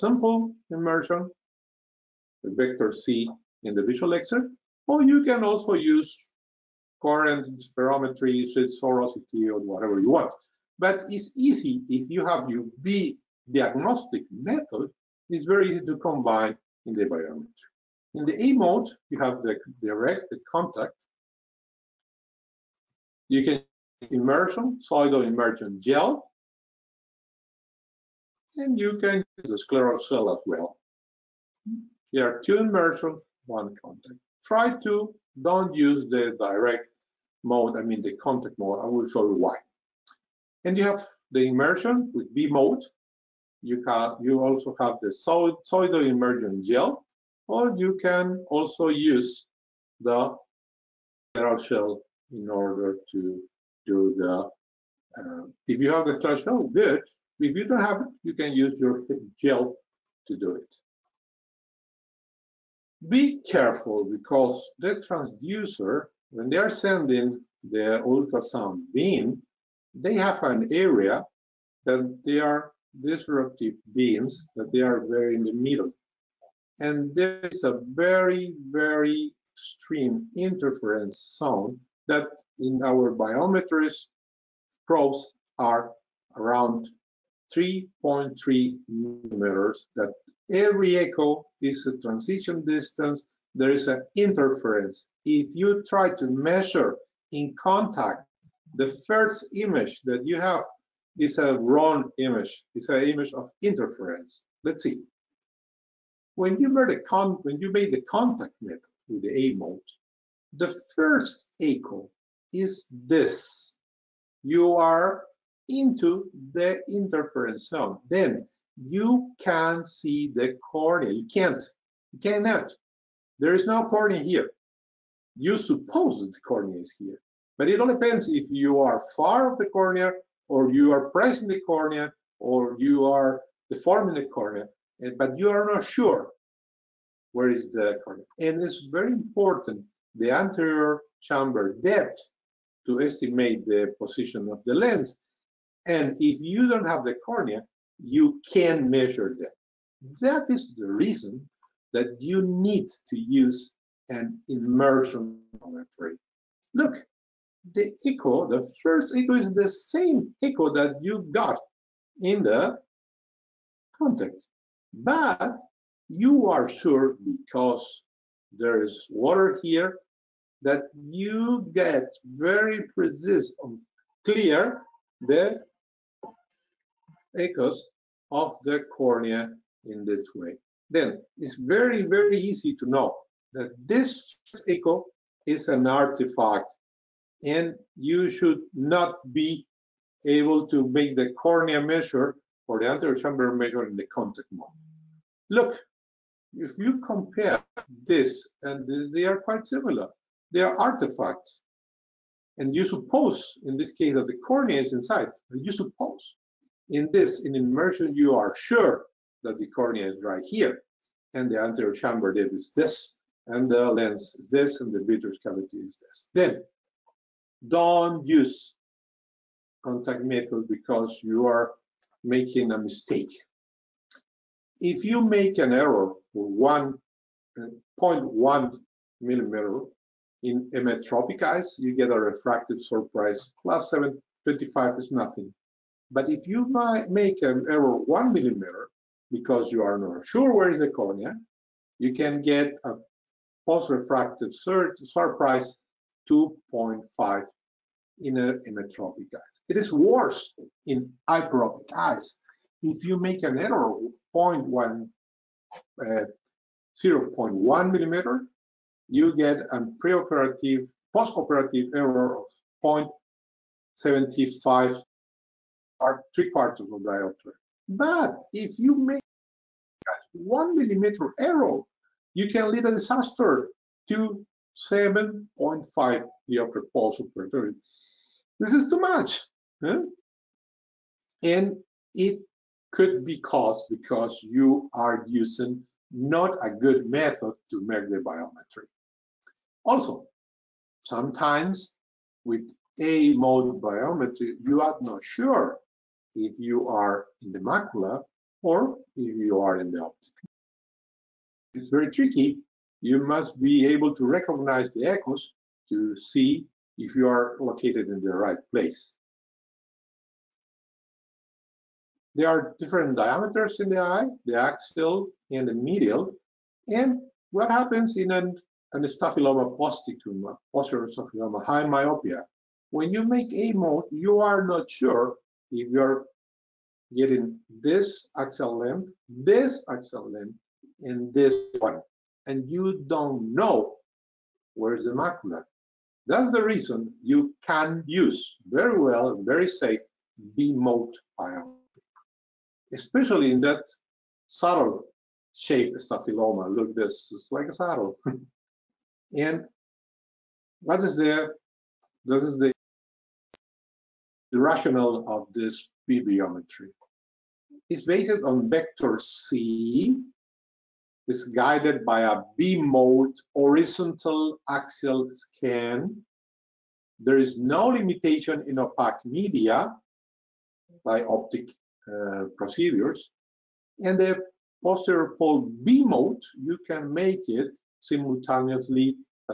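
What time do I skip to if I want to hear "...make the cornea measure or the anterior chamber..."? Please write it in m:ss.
3:10.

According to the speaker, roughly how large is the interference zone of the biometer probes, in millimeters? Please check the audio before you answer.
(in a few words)
3.3 millimeters.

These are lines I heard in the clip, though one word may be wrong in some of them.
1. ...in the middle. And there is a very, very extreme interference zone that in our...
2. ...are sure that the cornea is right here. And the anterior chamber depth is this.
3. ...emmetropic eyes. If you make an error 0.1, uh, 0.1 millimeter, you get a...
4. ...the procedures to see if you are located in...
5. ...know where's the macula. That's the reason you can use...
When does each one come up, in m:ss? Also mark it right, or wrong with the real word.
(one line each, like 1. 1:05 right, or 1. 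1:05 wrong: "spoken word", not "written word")
1. 1:15 right
2. 3:28 right
3. 4:11 wrong: "hyperopic", not "emmetropic"
4. 5:04 wrong: "echoes", not "procedures"
5. 5:33 right.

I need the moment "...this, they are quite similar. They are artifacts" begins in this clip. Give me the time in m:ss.
3:18.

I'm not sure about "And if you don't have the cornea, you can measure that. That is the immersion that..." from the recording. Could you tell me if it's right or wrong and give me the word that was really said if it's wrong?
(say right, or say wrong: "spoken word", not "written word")
wrong: "reason", not "immersion".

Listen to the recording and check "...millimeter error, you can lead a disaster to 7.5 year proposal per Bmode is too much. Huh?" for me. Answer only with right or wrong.
wrong.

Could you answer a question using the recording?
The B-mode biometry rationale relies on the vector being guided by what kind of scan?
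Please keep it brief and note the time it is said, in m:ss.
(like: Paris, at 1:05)
horizontal axial scan, at 6:03.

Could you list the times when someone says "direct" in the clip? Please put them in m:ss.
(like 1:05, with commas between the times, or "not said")
0:19, 0:36.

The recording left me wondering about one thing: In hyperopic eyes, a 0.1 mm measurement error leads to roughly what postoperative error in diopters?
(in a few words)
0.75.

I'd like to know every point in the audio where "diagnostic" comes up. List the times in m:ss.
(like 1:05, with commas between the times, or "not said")
0:13.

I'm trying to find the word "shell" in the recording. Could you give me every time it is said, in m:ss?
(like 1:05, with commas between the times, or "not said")
0:51, 0:56.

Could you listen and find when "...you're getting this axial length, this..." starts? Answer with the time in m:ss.
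5:25.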